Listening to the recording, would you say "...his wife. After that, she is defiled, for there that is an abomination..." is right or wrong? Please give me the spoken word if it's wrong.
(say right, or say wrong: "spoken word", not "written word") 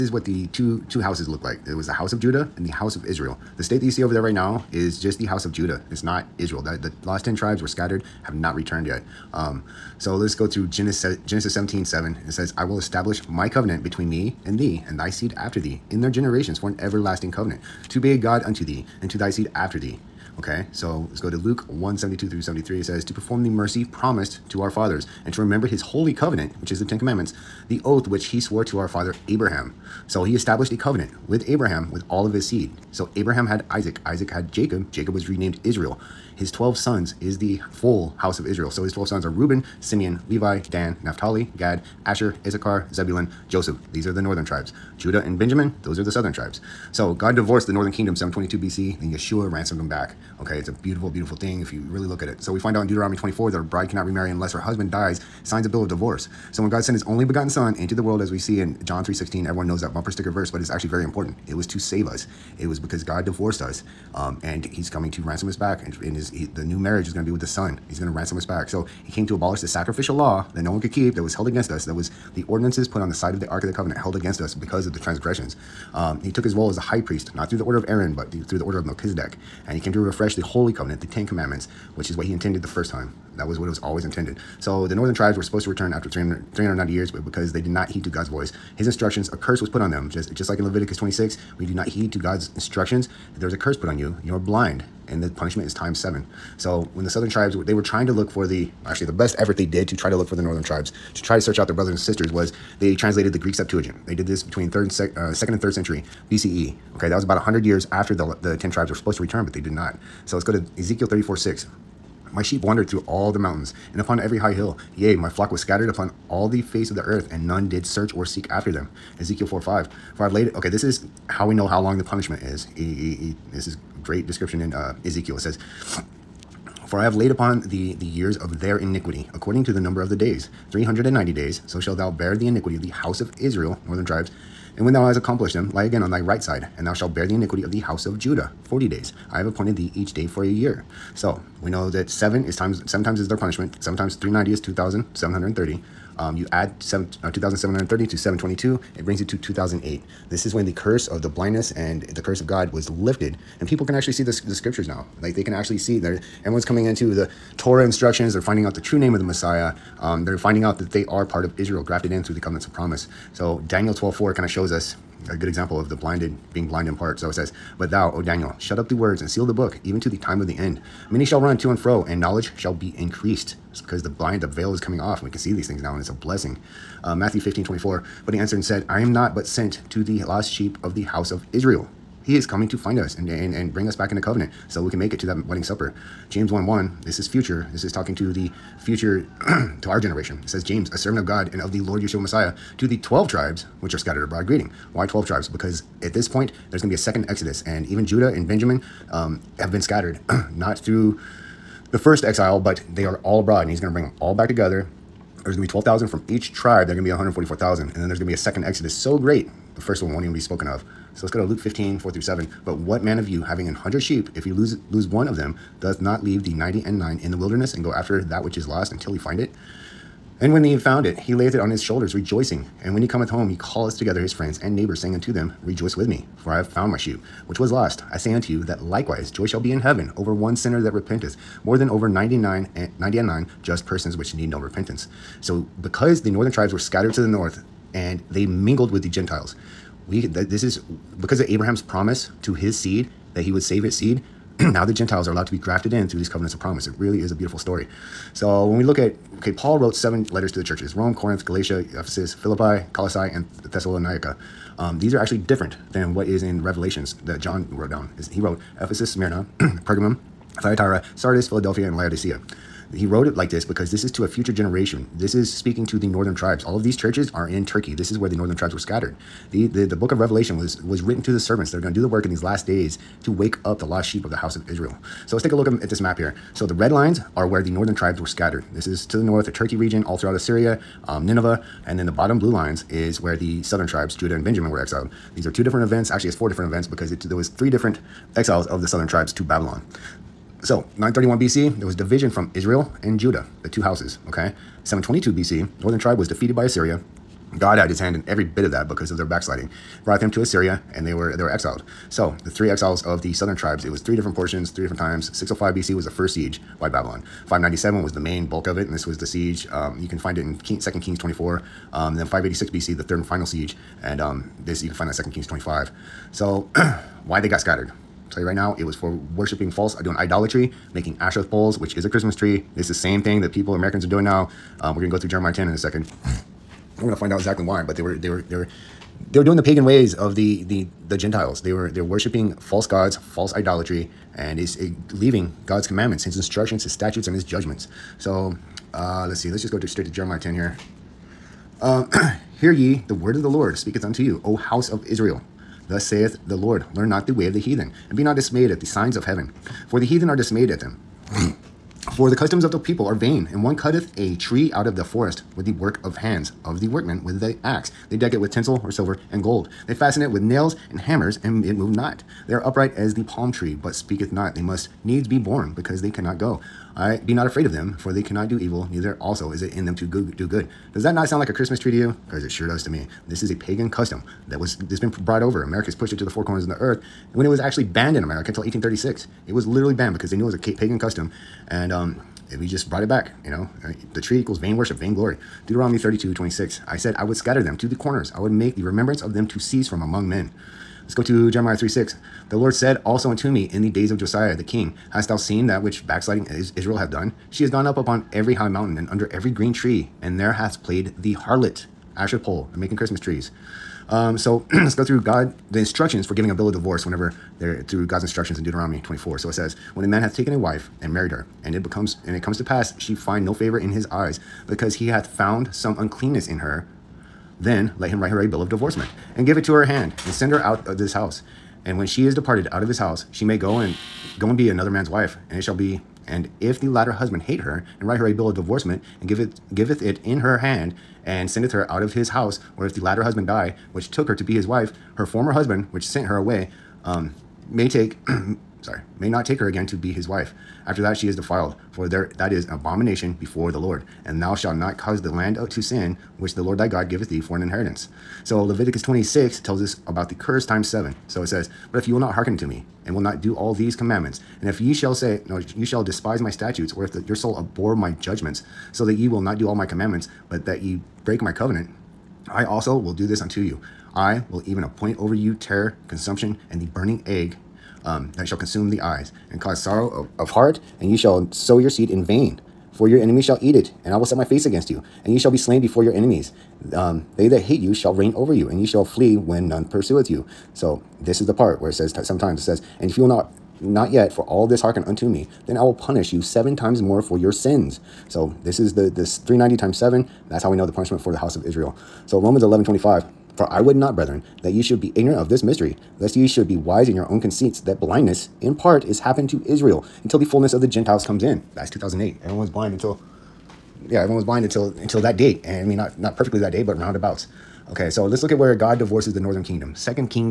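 right.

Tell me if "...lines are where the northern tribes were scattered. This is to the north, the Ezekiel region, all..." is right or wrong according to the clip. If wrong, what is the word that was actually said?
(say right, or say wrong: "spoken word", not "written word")
wrong: "Turkey", not "Ezekiel".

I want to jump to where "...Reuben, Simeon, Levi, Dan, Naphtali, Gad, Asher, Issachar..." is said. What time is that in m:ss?
0:39.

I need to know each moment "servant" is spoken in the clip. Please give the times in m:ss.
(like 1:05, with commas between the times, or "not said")
3:10, 4:31.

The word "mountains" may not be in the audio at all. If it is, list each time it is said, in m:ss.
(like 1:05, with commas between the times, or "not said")
1:53, 6:38.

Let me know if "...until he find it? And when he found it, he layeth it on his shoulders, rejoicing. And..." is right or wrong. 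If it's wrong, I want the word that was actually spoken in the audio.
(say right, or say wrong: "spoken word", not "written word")
right.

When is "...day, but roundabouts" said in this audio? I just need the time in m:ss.
8:26.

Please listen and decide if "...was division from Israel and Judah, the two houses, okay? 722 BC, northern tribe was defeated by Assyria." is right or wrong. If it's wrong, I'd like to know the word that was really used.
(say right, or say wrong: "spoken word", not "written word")
right.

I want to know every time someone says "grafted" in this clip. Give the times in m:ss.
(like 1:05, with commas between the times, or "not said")
2:41, 4:05.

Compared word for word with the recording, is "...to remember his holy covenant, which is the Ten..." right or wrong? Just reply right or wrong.
right.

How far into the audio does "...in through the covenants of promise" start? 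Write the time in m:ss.
2:42.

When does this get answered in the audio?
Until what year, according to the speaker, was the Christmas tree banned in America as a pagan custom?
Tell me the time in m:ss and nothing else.
6:18.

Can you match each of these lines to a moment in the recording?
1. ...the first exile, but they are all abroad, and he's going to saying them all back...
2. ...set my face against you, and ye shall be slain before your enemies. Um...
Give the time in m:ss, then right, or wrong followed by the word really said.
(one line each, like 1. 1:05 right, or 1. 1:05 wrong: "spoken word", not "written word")
1. 3:21 wrong: "bring", not "saying"
2. 7:54 right.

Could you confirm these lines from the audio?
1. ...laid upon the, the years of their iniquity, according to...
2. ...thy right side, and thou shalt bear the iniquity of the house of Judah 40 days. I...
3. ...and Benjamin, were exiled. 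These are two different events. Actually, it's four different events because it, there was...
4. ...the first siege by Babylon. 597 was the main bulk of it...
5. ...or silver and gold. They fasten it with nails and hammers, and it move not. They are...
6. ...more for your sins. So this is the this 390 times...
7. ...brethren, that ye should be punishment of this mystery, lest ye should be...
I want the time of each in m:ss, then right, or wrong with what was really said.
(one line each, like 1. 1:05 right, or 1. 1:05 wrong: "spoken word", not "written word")
1. 2:07 right
2. 2:16 right
3. 4:44 right
4. 5:06 right
5. 5:58 right
6. 8:07 right
7. 8:14 wrong: "ignorant", not "punishment".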